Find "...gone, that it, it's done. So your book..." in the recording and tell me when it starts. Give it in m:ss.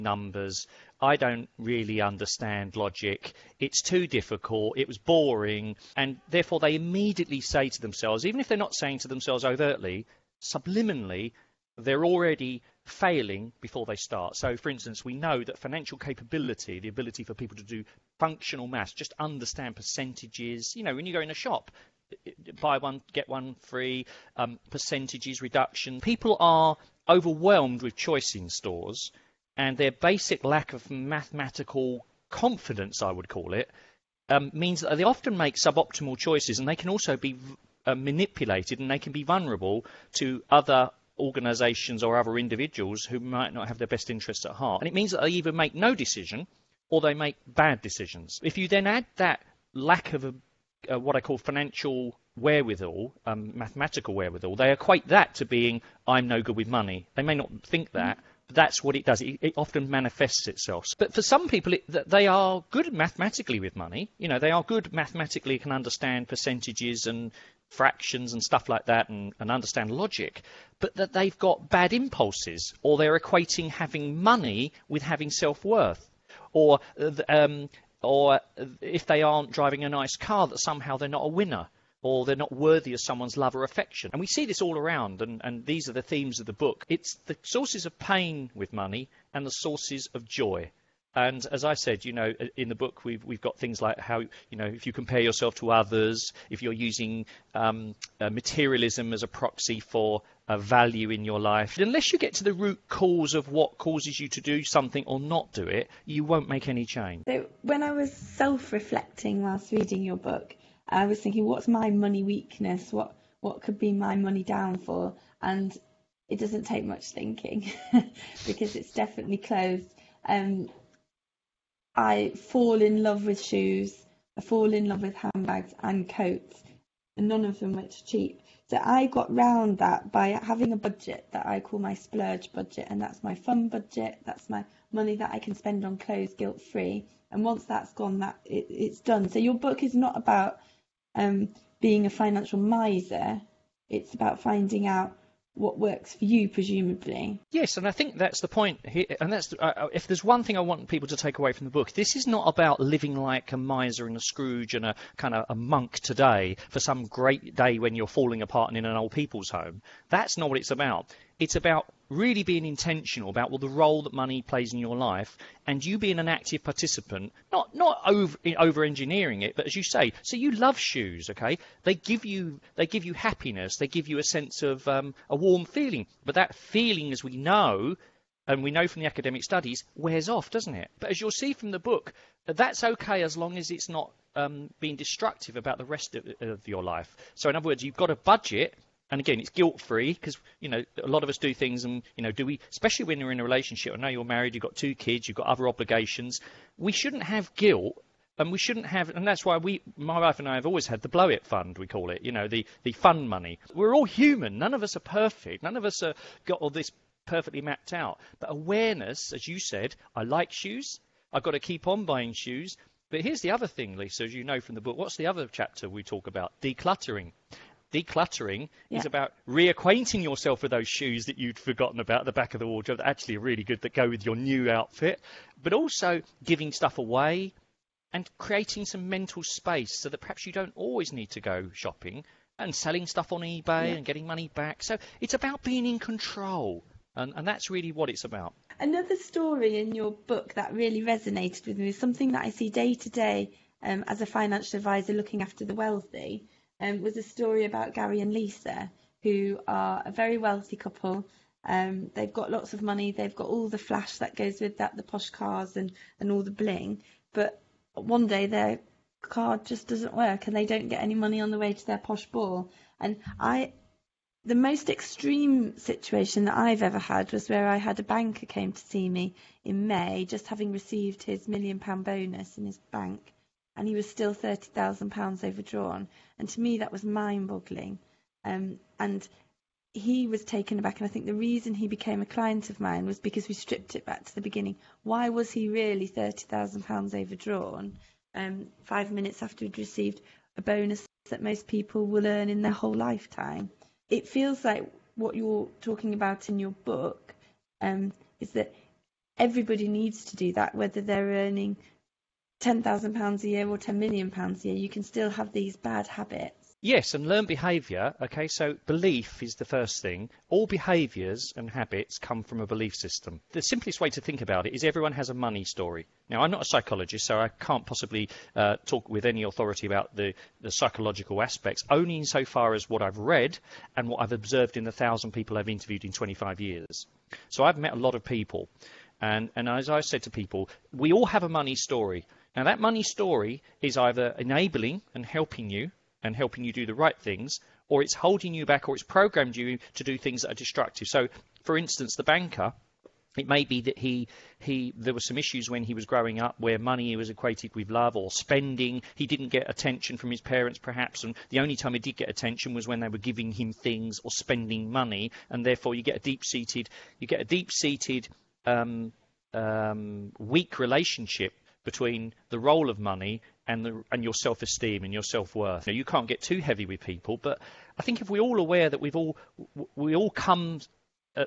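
2:17.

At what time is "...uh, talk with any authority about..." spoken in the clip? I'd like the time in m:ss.
5:18.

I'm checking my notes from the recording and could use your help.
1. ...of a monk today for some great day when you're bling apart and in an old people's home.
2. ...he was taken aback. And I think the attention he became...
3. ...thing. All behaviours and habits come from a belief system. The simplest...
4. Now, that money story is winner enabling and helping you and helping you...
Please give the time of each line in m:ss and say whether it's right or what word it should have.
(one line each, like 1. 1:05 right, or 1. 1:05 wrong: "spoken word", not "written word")
1. 2:35 wrong: "falling", not "bling"
2. 4:39 wrong: "reason", not "attention"
3. 5:10 right
4. 5:32 wrong: "either", not "winner".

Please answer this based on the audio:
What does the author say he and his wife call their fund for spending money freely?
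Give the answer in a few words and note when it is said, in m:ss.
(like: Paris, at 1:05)
blow it fund, at 3:21.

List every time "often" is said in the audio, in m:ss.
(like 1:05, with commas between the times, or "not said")
0:35, 0:59.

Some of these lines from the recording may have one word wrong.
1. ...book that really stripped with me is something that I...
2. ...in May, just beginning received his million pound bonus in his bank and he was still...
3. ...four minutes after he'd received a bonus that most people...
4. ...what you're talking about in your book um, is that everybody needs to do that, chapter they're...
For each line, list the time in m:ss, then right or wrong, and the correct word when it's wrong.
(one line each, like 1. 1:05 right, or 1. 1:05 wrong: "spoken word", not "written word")
1. 4:00 wrong: "resonated", not "stripped"
2. 4:29 wrong: "having", not "beginning"
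3. 4:48 wrong: "five", not "four"
4. 4:55 wrong: "whether", not "chapter".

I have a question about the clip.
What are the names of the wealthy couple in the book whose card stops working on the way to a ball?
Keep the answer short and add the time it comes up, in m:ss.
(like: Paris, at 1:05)
Gary and Lisa, at 4:07.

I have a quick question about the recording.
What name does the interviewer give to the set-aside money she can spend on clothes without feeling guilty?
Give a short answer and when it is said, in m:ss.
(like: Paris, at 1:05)
splurge budget, at 2:11.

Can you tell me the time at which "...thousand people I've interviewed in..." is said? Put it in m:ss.
5:24.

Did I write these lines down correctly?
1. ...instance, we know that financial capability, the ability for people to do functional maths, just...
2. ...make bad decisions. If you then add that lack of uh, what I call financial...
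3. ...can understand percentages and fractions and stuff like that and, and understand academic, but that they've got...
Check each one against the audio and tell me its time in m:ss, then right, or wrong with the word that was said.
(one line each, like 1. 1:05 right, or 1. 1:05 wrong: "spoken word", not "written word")
1. 0:14 right
2. 0:47 right
3. 1:05 wrong: "logic", not "academic".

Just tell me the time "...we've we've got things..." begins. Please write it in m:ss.
1:33.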